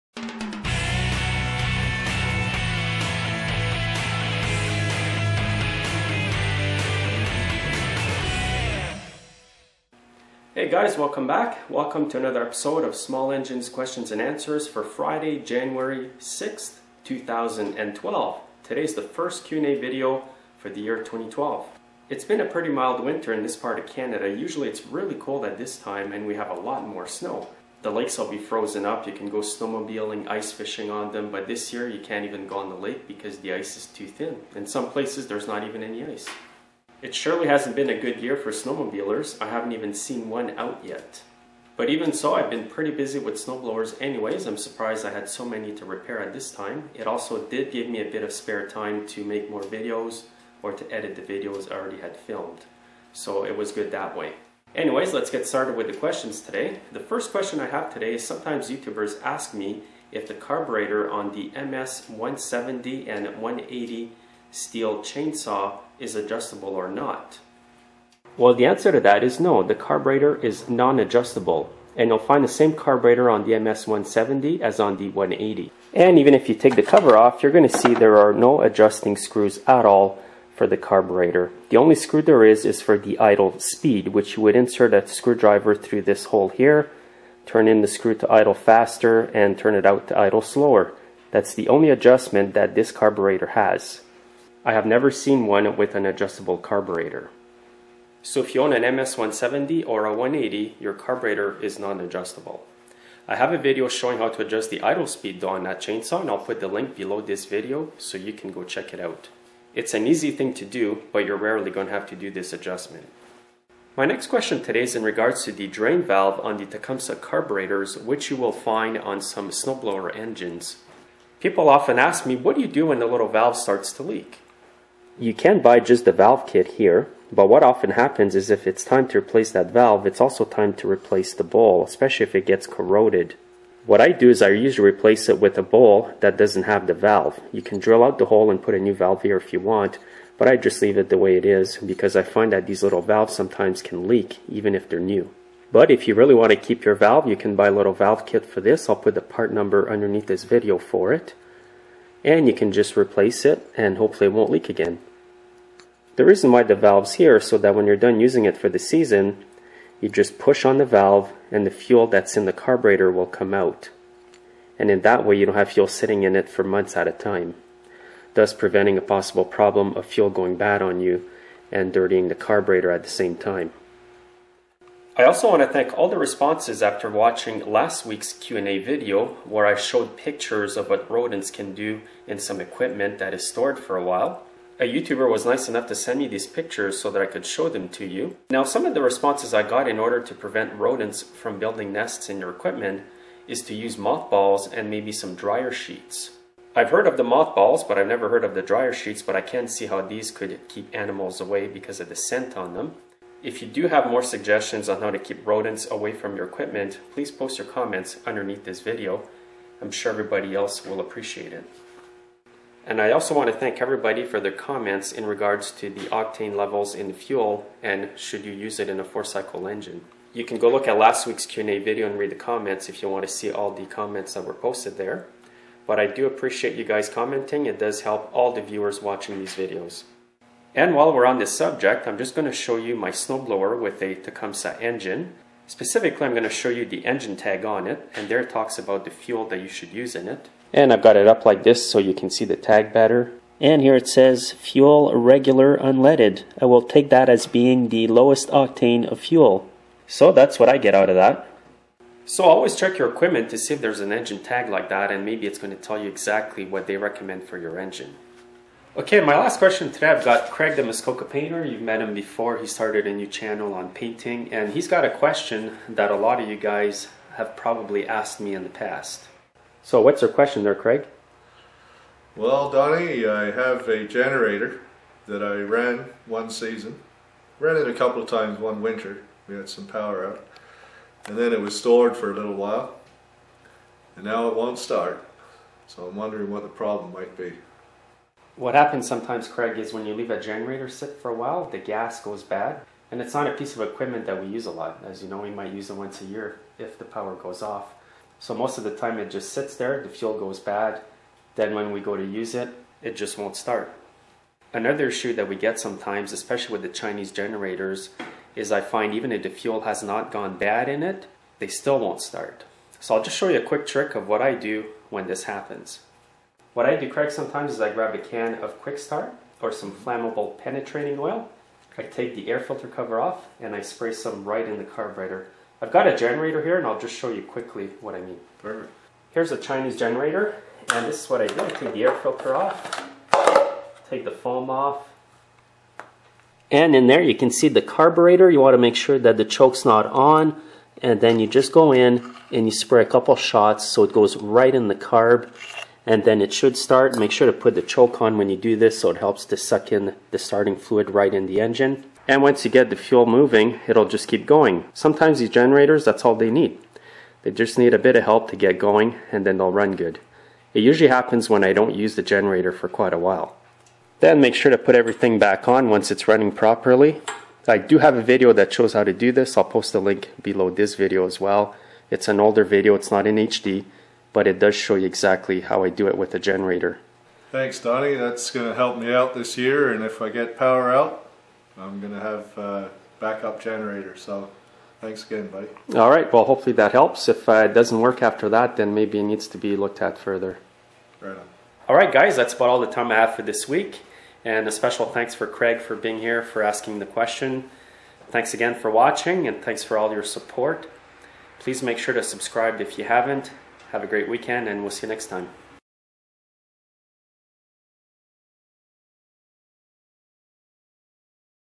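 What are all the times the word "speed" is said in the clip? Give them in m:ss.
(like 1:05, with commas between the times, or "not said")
1:23, 1:45.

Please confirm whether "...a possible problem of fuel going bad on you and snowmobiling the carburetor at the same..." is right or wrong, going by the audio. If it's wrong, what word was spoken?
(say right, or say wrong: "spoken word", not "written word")
wrong: "dirtying", not "snowmobiling".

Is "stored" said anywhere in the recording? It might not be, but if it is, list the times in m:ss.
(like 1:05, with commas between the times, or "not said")
3:03, 4:41.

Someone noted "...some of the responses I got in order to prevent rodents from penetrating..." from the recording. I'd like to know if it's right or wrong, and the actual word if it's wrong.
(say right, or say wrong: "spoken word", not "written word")
wrong: "building", not "penetrating".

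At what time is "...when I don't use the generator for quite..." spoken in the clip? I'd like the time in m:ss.
6:01.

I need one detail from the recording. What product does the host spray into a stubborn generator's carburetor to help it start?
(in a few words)
Quick Start.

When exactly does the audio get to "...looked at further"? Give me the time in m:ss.
6:29.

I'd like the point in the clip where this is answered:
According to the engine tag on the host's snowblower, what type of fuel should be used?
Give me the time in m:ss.
4:05.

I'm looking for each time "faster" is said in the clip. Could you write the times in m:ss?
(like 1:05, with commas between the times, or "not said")
1:28.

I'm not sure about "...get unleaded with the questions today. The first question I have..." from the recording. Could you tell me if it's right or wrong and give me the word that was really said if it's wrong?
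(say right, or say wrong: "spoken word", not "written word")
wrong: "started", not "unleaded".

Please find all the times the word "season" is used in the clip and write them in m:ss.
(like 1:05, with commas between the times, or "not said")
2:38, 4:36.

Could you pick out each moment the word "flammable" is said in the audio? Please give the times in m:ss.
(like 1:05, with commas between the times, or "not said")
5:19.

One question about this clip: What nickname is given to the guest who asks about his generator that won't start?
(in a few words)
Muskoka painter.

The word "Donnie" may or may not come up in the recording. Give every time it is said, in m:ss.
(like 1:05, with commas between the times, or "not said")
4:32, 6:17.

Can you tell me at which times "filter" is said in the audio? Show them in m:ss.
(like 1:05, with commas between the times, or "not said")
5:22, 5:32.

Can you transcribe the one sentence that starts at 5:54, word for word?
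Sometimes these generators, that's all they need.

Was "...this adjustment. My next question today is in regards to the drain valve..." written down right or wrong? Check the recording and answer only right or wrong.
right.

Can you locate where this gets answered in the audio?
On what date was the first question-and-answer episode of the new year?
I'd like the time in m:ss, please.
0:15.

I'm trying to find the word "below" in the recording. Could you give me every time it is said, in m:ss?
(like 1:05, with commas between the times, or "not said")
1:46, 6:10.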